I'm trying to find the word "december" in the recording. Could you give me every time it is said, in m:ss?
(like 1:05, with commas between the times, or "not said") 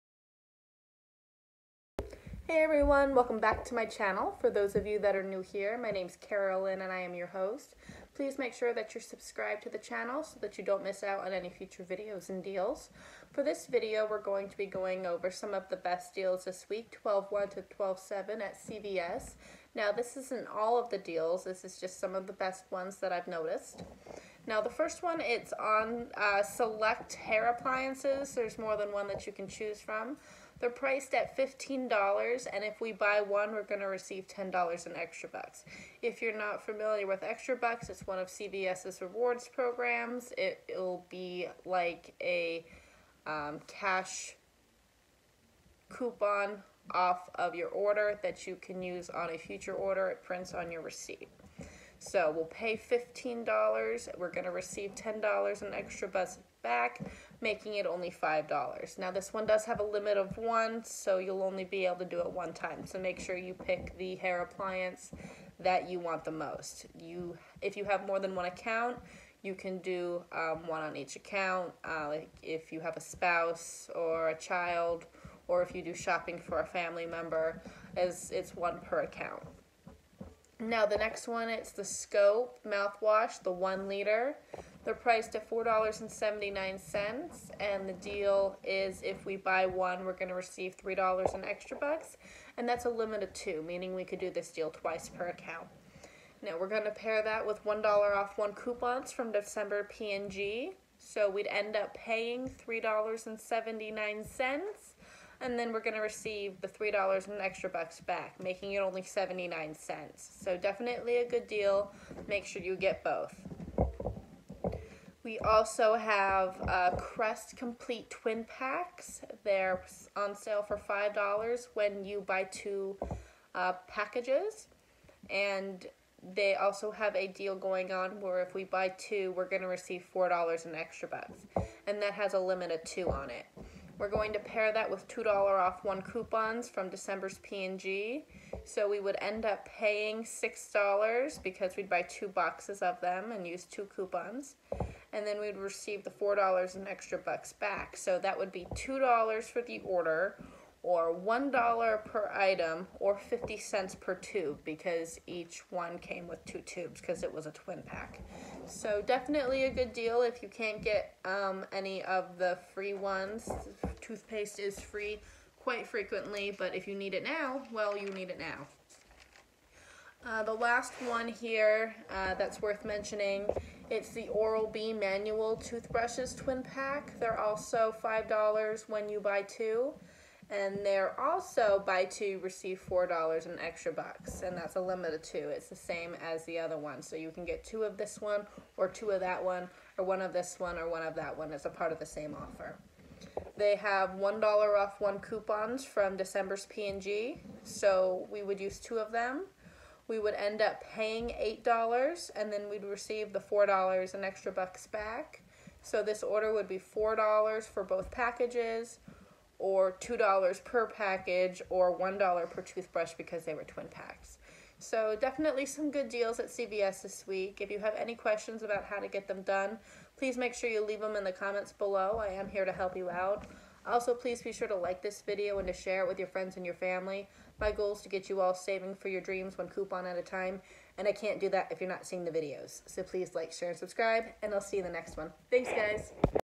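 1:39, 2:16, 3:16.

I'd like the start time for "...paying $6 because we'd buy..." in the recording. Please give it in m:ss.
2:19.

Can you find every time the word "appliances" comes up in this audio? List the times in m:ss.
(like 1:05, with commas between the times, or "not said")
0:27, 1:04.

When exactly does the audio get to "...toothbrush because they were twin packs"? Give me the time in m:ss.
3:32.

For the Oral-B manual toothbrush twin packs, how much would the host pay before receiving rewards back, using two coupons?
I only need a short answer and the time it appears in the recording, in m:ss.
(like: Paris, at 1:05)
$8, at 3:21.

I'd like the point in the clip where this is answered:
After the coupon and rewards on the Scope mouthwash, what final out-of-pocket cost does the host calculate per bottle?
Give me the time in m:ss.
1:49.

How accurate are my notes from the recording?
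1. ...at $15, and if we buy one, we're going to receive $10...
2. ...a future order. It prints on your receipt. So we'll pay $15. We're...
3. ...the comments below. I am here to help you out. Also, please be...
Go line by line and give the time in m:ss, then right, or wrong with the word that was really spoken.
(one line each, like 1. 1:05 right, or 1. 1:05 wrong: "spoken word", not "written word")
1. 0:31 right
2. 0:49 right
3. 3:41 right.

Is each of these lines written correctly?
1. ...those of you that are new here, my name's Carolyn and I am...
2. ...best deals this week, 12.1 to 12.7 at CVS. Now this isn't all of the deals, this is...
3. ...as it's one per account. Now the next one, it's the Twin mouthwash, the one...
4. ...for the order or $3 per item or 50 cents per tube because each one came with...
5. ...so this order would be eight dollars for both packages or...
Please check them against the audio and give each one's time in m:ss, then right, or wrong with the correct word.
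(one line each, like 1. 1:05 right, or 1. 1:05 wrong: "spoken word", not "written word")
1. 0:04 right
2. 0:15 right
3. 1:17 wrong: "Scope", not "Twin"
4. 2:29 wrong: "1", not "3"
5. 3:25 wrong: "four", not "eight".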